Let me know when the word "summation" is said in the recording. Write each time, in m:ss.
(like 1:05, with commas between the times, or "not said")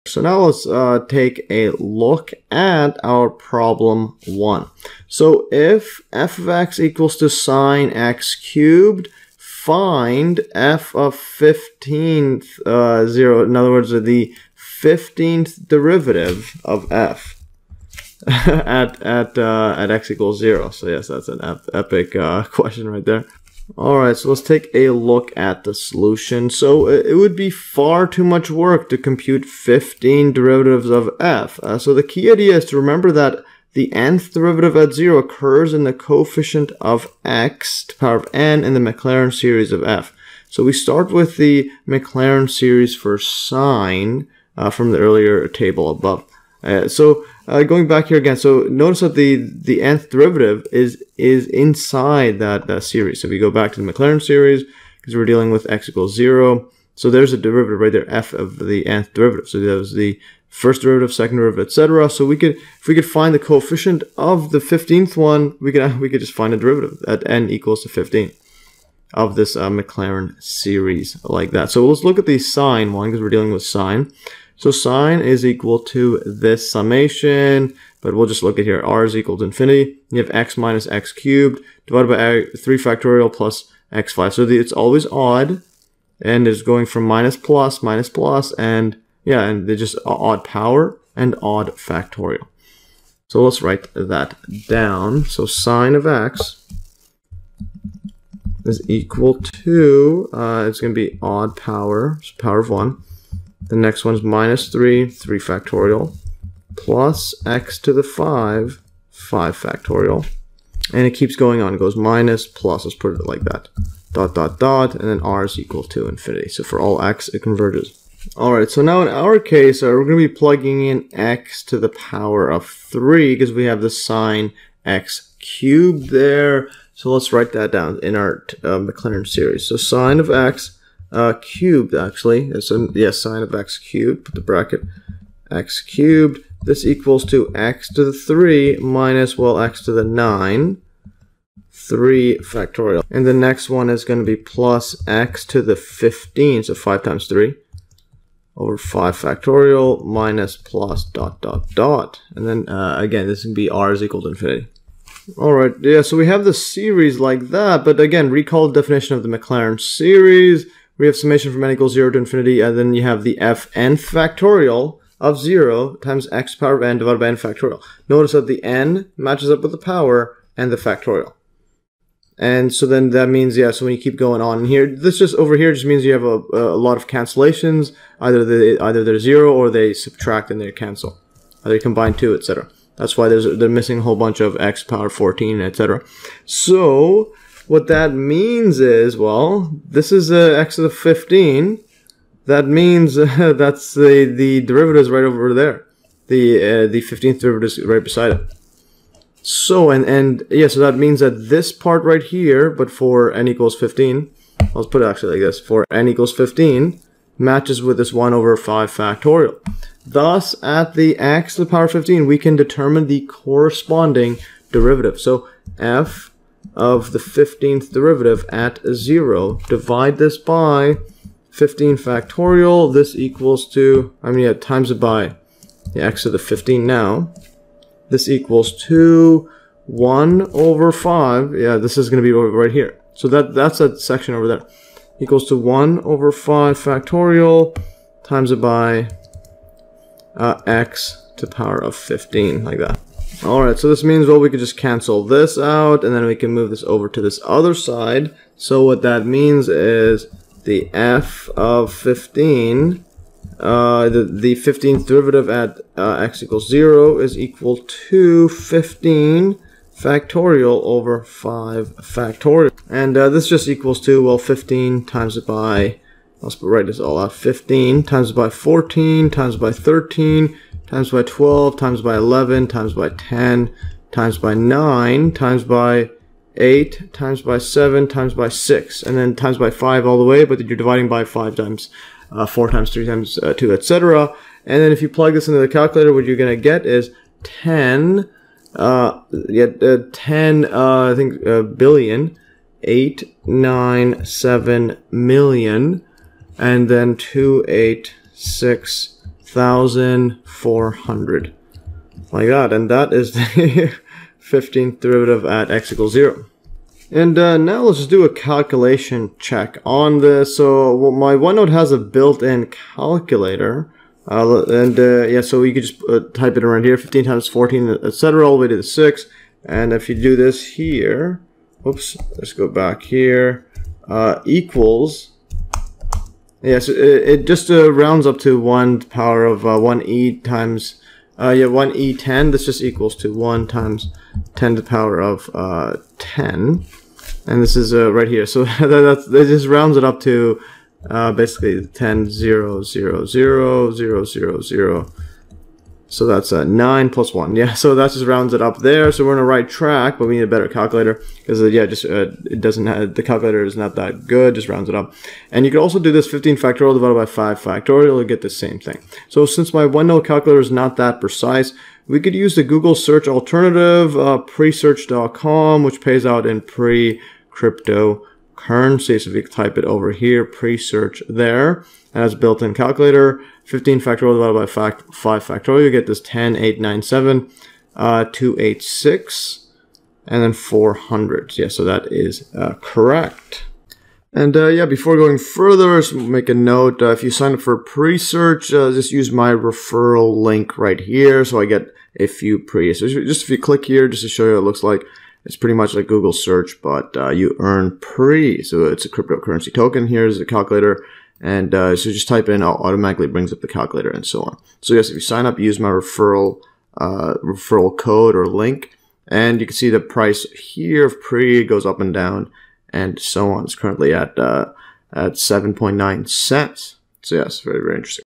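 1:16, 2:41.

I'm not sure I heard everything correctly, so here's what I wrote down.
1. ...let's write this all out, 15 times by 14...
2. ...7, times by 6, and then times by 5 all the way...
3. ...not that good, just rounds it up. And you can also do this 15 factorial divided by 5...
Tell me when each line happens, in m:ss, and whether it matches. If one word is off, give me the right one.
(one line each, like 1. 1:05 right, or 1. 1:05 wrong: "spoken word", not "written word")
1. 4:26 right
2. 4:37 right
3. 5:53 right.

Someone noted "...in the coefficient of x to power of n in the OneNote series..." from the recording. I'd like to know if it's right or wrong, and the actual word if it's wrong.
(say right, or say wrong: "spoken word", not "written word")
wrong: "Maclaurin", not "OneNote".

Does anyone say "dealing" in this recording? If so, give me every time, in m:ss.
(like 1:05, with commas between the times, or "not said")
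0:55, 1:13.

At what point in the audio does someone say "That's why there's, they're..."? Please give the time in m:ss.
3:02.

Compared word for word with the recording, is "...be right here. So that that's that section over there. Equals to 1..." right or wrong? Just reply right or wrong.
right.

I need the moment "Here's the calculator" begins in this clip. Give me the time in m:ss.
6:40.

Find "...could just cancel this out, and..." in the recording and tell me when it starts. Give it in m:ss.
4:04.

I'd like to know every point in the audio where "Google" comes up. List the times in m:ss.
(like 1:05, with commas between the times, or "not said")
6:02, 6:36.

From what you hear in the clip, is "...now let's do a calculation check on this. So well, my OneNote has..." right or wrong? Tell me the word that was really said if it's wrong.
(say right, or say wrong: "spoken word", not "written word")
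right.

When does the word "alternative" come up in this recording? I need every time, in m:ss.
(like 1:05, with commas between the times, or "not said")
6:03.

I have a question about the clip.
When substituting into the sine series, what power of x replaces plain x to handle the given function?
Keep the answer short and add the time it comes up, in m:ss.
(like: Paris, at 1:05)
3, at 2:01.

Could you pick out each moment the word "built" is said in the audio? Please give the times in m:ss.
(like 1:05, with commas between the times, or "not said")
5:11, 6:12.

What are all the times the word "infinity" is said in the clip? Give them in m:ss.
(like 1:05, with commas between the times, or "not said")
1:19, 1:56, 2:34, 2:42.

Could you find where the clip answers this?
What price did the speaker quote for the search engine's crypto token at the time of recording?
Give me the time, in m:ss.
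6:55.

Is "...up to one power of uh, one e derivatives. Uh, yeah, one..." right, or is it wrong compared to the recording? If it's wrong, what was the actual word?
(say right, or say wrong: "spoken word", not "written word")
wrong: "times", not "derivatives".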